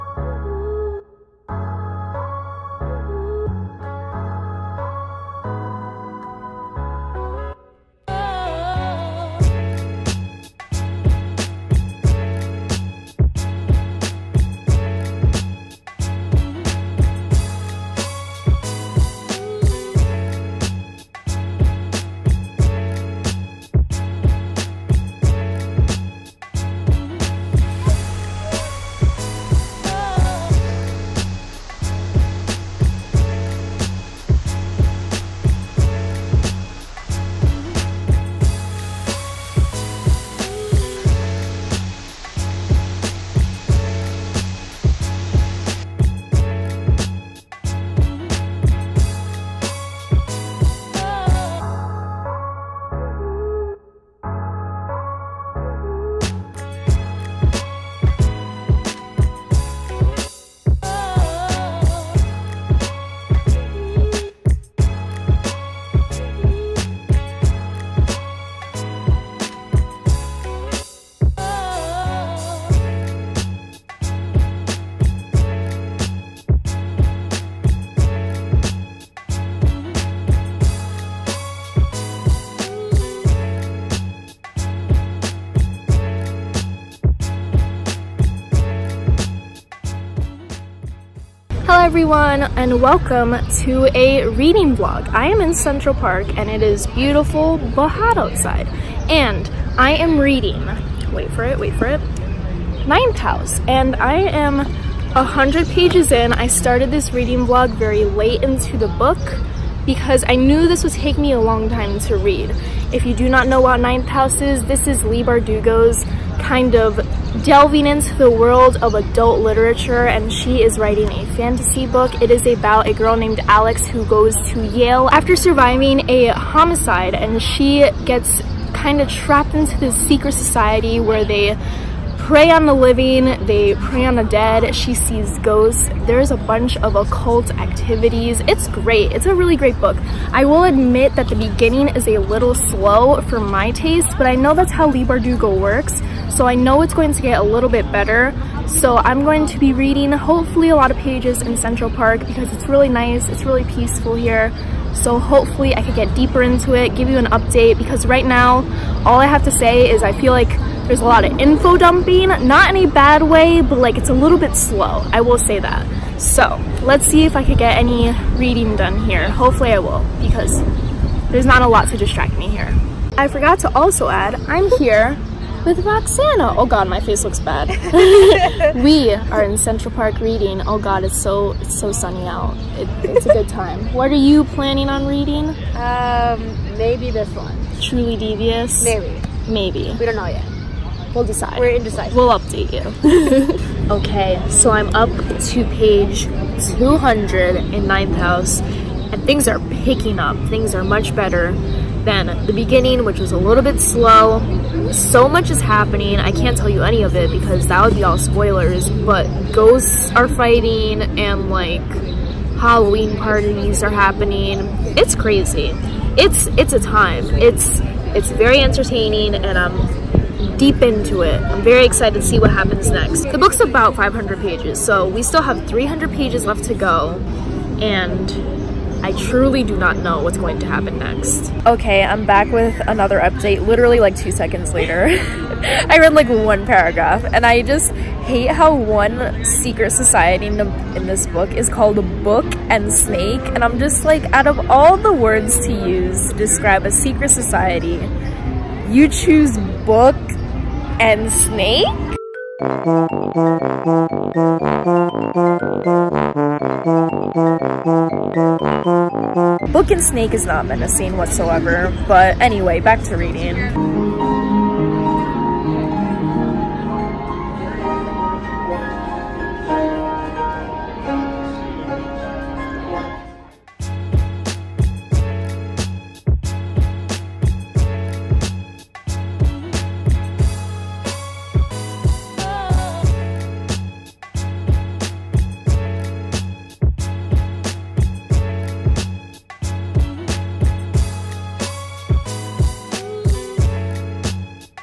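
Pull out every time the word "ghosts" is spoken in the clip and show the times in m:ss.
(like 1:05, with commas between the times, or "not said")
2:15, 3:29.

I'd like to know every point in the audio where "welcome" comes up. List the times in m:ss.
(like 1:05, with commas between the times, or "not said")
1:32.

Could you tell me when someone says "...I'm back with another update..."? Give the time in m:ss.
3:52.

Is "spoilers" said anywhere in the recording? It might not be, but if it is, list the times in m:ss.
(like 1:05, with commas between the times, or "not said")
3:28.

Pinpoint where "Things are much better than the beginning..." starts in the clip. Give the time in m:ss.
3:20.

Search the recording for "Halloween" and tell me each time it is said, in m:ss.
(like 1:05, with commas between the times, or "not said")
3:32.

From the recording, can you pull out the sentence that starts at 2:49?
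Hopefully I will because there's not a lot to distract me here.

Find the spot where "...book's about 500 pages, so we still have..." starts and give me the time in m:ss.
3:43.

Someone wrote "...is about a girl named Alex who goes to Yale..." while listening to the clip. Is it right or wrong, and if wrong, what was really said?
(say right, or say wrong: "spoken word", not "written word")
right.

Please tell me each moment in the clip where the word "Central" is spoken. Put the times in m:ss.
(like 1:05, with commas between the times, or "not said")
1:35, 2:31, 2:59.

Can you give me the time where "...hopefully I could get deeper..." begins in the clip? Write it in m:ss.
2:35.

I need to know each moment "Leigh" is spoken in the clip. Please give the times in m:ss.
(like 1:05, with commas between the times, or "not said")
1:55, 2:24.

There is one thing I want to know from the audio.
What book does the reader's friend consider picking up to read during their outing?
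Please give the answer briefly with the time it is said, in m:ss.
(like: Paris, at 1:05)
Truly Devious, at 3:07.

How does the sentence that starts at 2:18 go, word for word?
It's great, it's a really great book.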